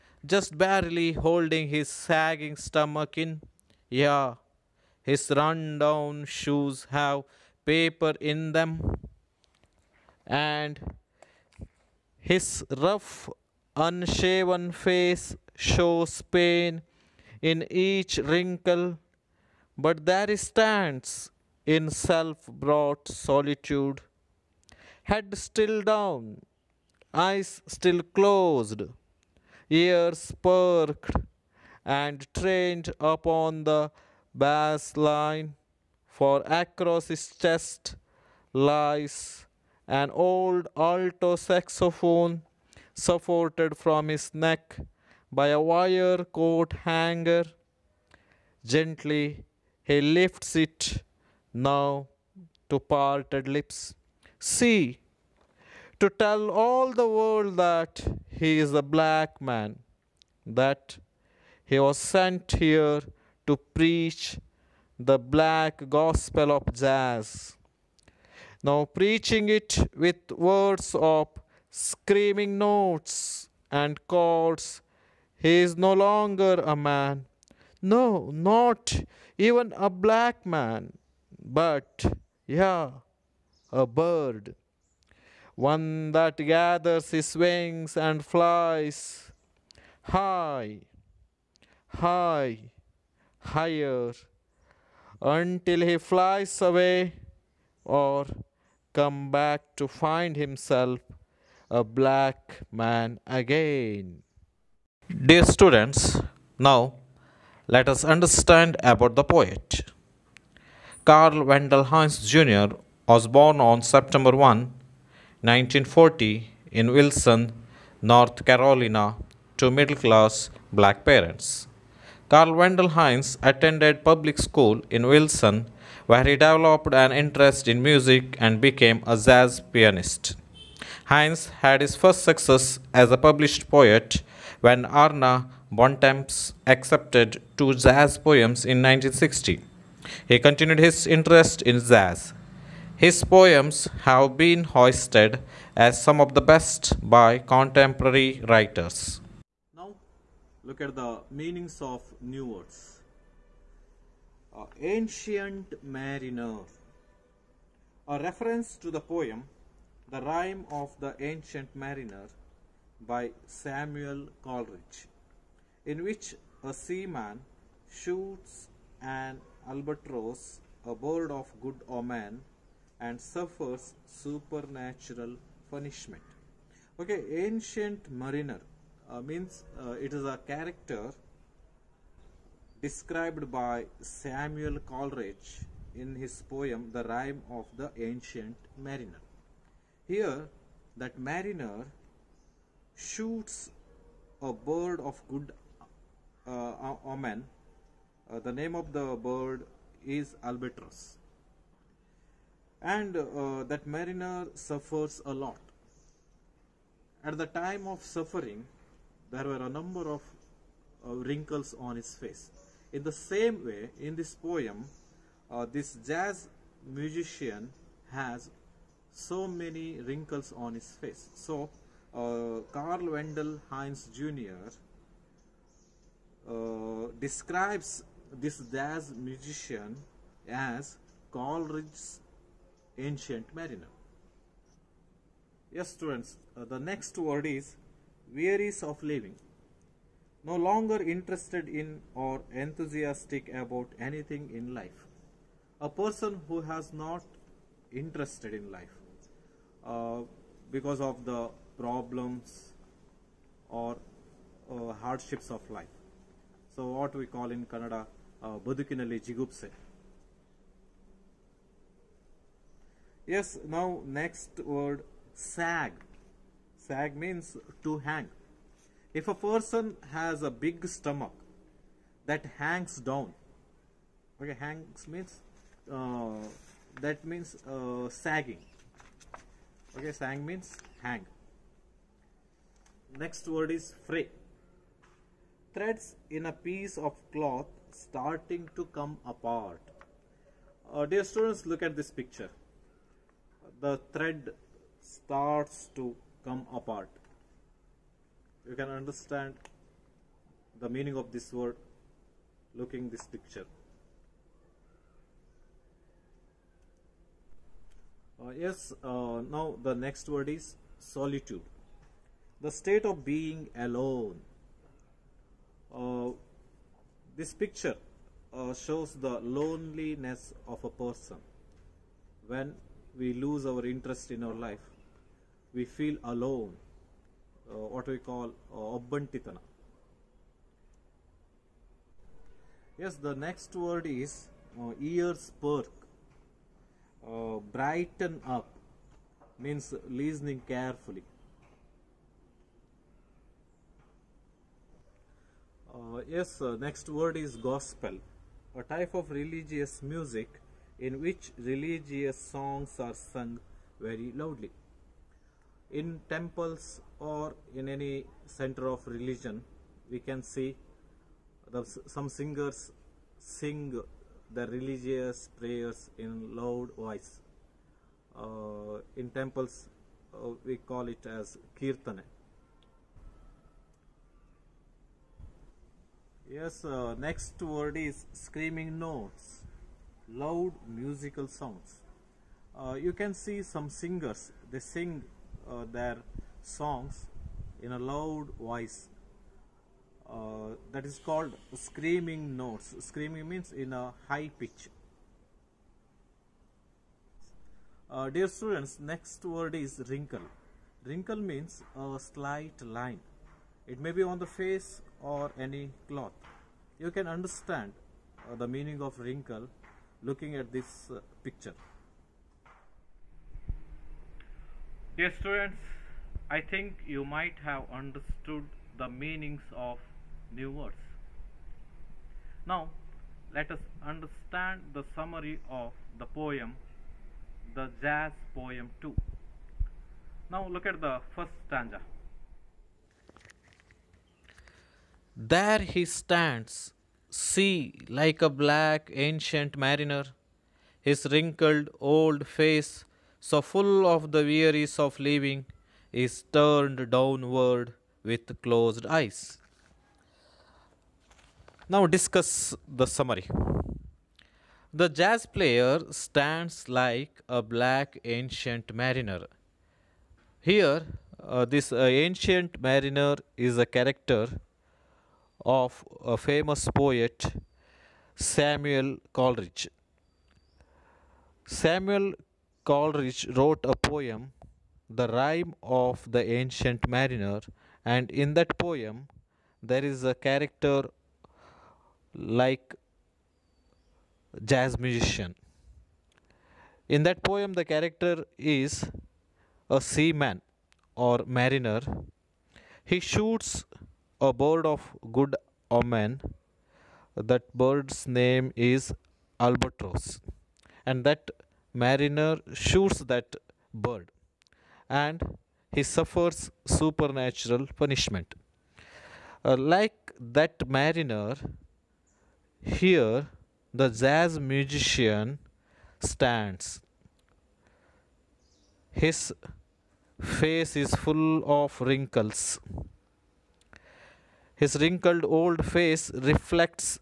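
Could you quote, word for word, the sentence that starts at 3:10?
Here, that mariner shoots a bird of good uh, omen.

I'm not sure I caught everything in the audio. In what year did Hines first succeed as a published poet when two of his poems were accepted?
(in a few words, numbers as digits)
1960.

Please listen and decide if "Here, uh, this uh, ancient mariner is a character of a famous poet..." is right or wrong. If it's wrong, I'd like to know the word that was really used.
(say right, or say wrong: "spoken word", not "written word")
right.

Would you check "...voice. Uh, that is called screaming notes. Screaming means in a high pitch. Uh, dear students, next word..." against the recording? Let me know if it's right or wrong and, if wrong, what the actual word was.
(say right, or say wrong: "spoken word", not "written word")
right.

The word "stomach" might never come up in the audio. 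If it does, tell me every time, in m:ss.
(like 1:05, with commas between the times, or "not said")
0:02, 4:30.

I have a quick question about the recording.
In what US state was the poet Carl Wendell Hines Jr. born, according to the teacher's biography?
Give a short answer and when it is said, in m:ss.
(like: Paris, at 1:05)
North Carolina, at 1:58.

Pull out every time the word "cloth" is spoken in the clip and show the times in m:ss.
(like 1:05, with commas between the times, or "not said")
4:47, 6:46.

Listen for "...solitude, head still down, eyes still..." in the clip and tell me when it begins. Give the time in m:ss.
0:23.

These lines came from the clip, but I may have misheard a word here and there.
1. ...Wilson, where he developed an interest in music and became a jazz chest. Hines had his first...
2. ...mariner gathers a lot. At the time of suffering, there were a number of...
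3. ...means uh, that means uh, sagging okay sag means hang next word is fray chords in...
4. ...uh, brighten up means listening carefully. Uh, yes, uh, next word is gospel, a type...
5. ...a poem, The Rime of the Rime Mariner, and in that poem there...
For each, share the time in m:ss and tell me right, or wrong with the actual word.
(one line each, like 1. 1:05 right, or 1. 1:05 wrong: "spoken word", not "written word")
1. 2:05 wrong: "pianist", not "chest"
2. 3:23 wrong: "suffers", not "gathers"
3. 4:35 wrong: "threads", not "chords"
4. 5:37 right
5. 7:53 wrong: "Ancient", not "Rime".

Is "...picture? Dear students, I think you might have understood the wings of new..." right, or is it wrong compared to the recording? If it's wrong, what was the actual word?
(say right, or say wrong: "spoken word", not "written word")
wrong: "meanings", not "wings".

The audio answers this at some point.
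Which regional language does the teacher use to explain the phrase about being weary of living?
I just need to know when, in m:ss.
4:17.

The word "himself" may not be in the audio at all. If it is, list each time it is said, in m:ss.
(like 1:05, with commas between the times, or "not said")
1:40.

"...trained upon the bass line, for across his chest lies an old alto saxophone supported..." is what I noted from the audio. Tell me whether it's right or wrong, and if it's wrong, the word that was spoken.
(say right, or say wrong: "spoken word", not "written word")
right.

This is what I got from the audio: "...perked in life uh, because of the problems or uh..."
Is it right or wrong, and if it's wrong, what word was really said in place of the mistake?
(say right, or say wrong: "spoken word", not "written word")
wrong: "interested", not "perked".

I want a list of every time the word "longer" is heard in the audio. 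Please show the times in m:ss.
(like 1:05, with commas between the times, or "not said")
1:15, 4:00.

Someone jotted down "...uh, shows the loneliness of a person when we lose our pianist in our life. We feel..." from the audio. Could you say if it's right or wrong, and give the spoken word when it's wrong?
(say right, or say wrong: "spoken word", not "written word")
wrong: "interest", not "pianist".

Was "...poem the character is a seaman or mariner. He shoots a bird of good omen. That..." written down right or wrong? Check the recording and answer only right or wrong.
right.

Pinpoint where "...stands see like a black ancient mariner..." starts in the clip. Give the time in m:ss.
7:16.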